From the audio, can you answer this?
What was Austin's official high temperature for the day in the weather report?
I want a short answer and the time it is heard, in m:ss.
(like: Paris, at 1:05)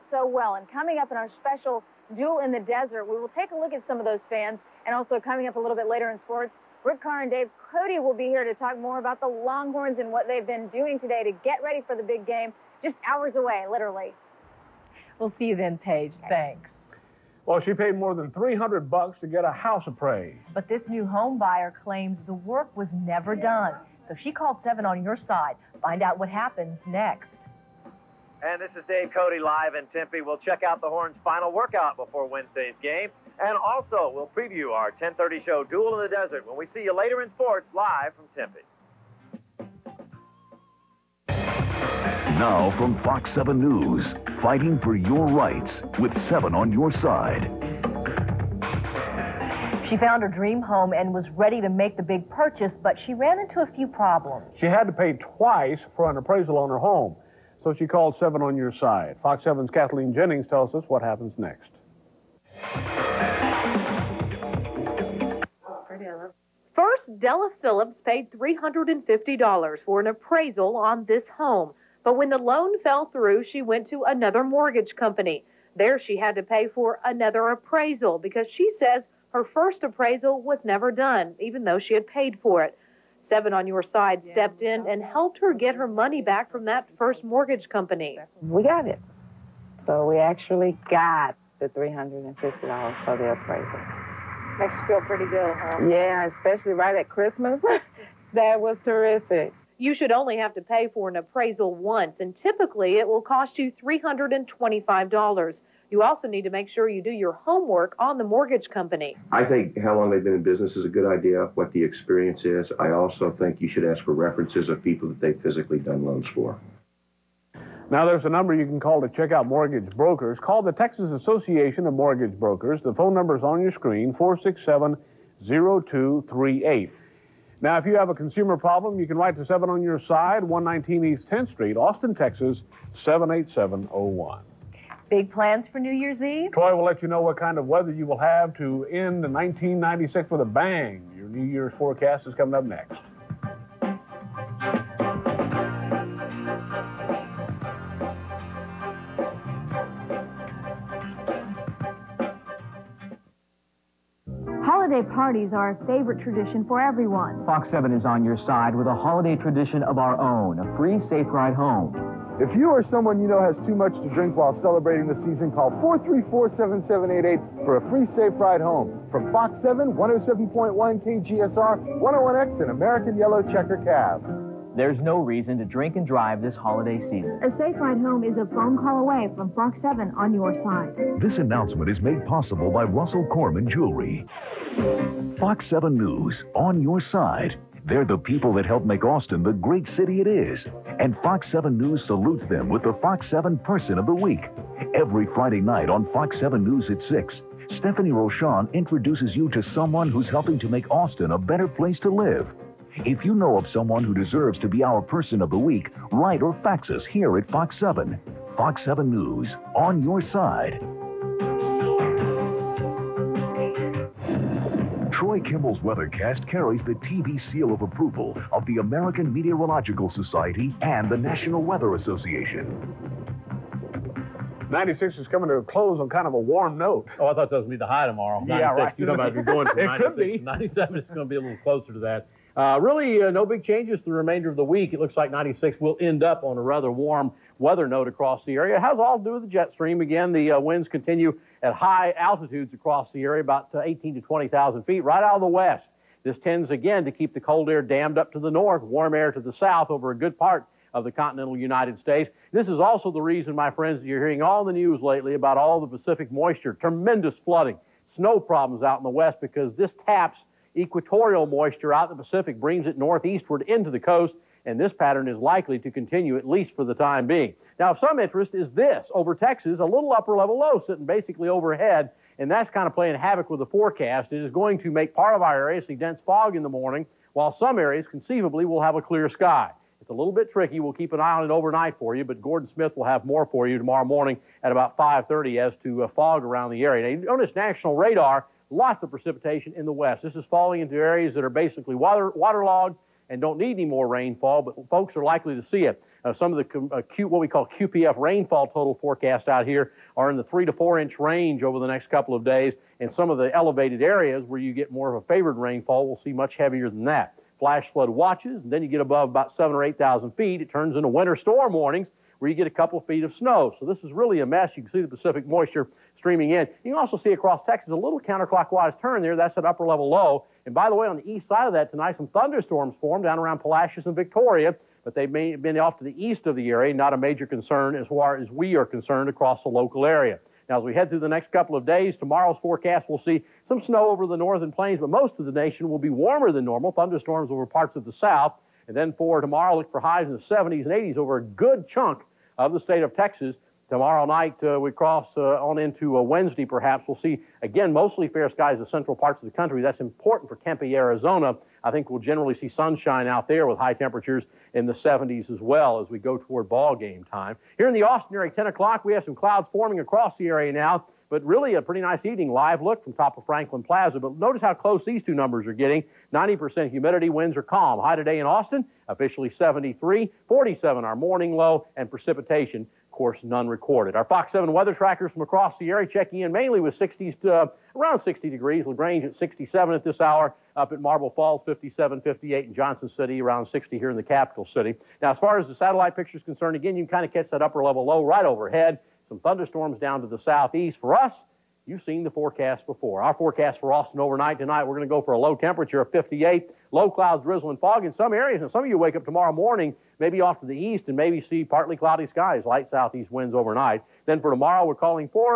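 73, at 6:09.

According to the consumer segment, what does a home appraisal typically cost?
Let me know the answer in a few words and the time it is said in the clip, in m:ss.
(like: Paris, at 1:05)
$325, at 1:43.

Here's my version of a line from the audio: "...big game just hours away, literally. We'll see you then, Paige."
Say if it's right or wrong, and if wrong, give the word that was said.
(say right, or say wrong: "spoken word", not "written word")
right.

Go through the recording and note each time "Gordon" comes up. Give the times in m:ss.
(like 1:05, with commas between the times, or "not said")
4:42.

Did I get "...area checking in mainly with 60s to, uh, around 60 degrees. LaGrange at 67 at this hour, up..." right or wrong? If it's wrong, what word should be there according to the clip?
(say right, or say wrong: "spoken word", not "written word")
right.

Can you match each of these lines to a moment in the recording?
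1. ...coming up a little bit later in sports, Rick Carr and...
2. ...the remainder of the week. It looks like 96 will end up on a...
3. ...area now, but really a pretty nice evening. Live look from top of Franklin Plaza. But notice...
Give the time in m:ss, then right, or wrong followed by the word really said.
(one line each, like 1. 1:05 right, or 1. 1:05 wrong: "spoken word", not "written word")
1. 0:05 right
2. 3:54 right
3. 6:00 right.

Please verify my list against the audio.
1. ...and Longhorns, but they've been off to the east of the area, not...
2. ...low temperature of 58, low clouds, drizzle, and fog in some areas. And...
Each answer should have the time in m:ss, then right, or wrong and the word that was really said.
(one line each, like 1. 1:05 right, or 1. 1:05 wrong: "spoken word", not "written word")
1. 5:24 wrong: "Victoria", not "Longhorns"
2. 6:35 right.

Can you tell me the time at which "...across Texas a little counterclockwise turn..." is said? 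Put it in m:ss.
5:17.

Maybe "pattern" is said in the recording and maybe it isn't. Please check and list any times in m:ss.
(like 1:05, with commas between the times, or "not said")
4:24.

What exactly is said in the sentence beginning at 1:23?
Seven on your side stepped in and helped her get her money back from that first mortgage company.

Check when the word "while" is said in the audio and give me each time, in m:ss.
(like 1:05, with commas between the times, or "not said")
2:44, 4:37.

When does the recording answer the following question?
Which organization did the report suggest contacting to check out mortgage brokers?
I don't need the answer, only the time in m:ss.
2:00.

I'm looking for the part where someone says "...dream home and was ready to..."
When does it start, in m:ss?
0:50.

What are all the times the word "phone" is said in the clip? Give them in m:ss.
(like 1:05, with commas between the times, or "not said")
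2:02, 2:58.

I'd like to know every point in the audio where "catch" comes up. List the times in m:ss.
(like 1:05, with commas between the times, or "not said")
6:27.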